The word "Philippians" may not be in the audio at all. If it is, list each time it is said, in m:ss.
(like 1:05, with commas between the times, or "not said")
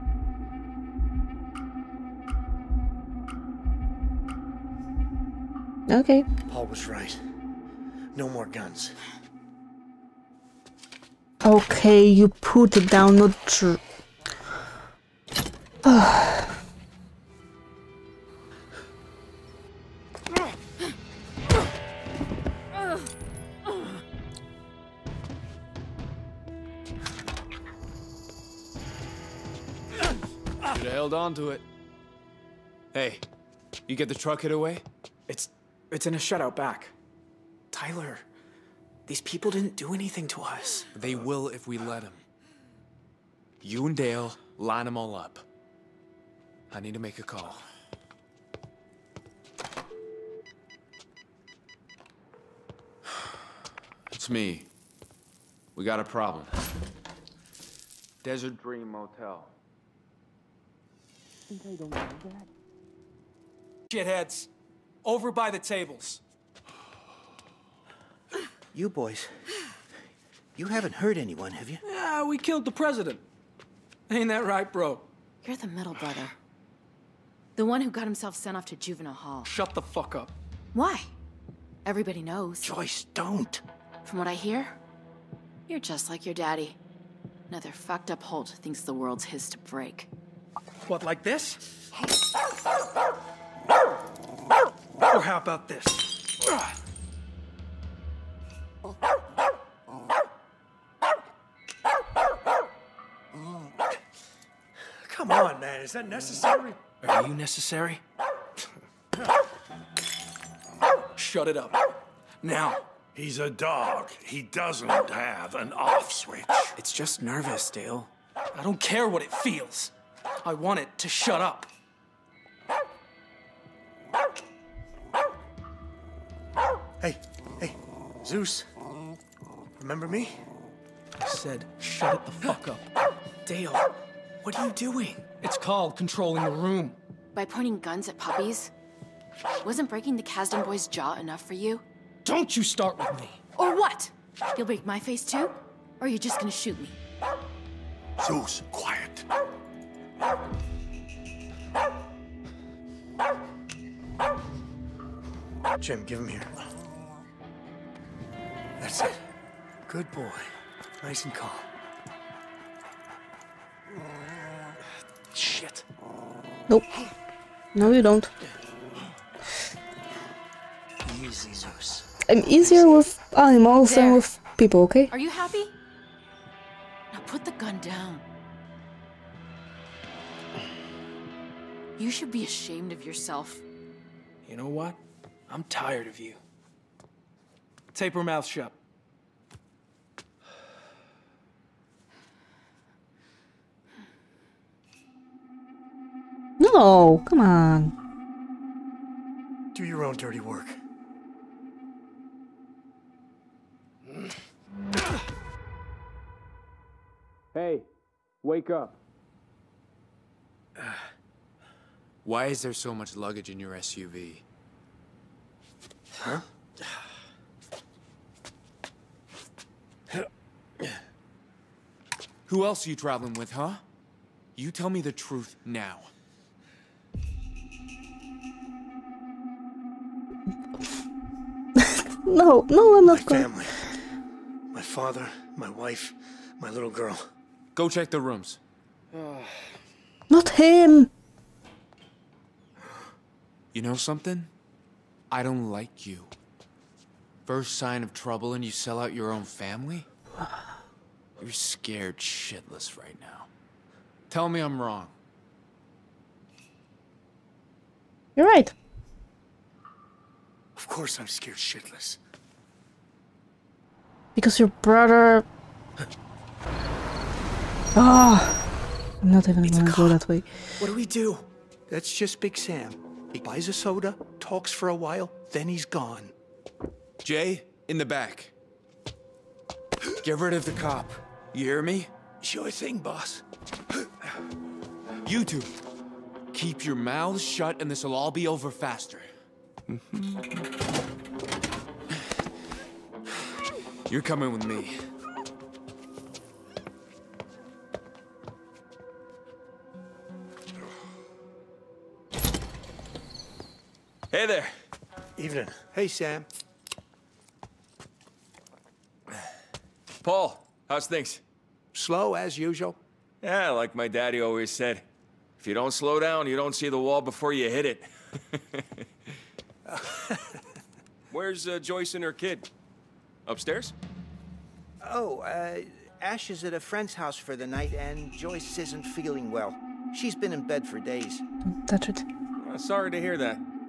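not said.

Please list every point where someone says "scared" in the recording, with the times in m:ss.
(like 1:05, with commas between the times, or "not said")
4:11, 4:21.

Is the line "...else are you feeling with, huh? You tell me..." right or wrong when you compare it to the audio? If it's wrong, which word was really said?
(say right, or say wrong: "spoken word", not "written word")
wrong: "traveling", not "feeling".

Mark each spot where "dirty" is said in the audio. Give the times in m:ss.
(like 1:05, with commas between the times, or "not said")
3:20.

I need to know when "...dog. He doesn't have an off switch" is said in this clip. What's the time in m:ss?
1:53.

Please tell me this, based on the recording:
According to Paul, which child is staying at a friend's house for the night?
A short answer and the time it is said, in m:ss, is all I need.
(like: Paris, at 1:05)
Ash, at 5:26.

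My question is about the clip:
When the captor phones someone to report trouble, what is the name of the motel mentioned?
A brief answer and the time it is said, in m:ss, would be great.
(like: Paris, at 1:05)
Desert Dream Motel, at 0:58.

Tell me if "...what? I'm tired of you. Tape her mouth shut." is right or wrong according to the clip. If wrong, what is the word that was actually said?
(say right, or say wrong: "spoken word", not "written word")
right.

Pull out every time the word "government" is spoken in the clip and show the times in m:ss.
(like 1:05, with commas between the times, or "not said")
not said.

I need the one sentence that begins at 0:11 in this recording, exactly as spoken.
Okay, you put it down, the true.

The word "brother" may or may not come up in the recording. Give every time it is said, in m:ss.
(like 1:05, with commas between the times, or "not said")
1:15, 4:24.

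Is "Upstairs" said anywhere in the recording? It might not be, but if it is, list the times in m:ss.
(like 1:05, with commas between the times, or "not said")
5:23.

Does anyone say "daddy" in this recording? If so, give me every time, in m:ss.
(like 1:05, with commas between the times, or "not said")
1:26, 5:14.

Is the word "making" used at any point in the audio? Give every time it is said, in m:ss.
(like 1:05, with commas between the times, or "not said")
not said.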